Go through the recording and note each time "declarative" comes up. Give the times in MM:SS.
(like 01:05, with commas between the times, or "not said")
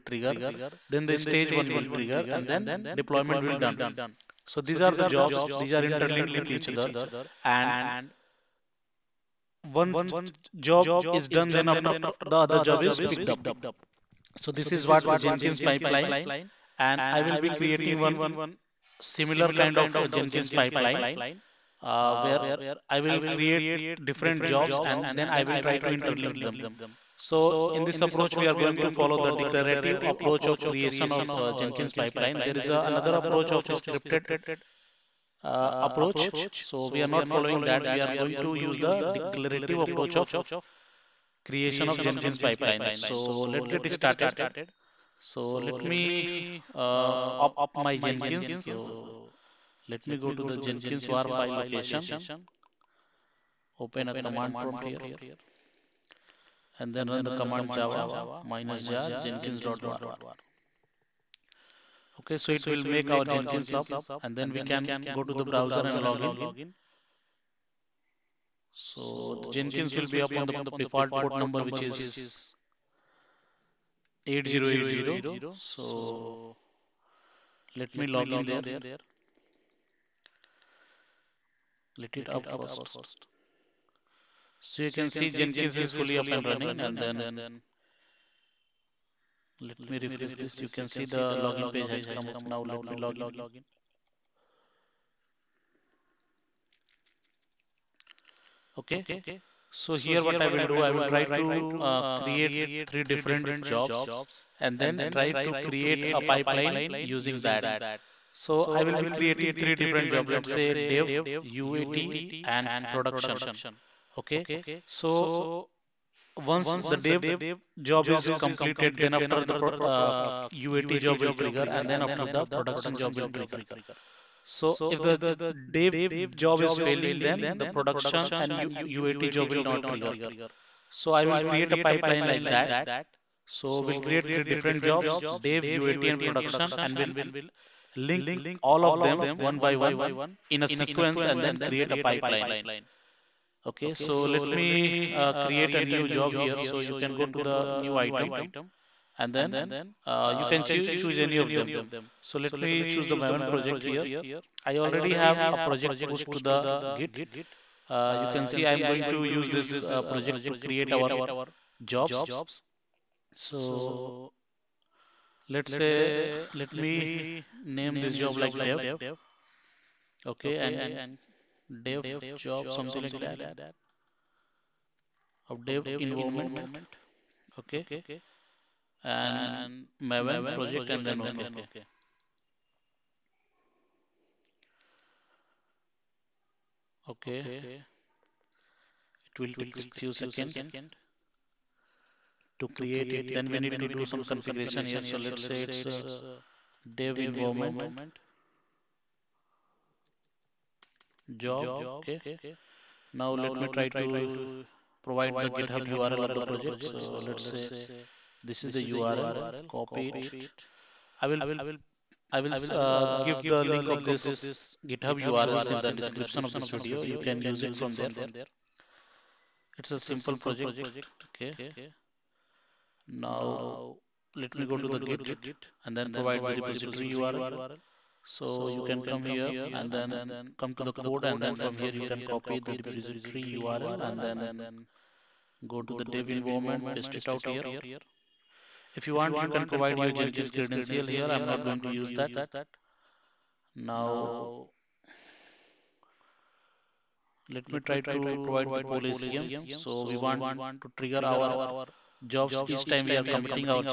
00:29, 00:39.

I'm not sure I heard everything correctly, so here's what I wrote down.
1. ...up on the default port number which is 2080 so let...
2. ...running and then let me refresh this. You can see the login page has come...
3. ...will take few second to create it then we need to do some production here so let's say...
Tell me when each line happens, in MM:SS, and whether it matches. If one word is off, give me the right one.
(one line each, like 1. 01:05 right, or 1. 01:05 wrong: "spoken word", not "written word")
1. 01:10 wrong: "8080", not "2080"
2. 01:26 right
3. 03:09 wrong: "configuration", not "production".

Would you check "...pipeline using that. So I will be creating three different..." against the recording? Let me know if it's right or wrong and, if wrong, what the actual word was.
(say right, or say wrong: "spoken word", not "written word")
right.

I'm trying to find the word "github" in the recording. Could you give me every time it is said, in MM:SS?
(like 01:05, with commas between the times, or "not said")
03:25, 03:34.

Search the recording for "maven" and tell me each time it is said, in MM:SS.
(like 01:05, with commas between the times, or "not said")
02:33, 03:00.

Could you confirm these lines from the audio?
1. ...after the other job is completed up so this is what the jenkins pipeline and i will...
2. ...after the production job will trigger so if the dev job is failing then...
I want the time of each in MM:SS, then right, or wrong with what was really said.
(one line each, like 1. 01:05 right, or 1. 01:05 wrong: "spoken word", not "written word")
1. 00:11 wrong: "picked", not "completed"
2. 02:02 right.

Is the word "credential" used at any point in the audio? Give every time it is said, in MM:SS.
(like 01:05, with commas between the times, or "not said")
04:00.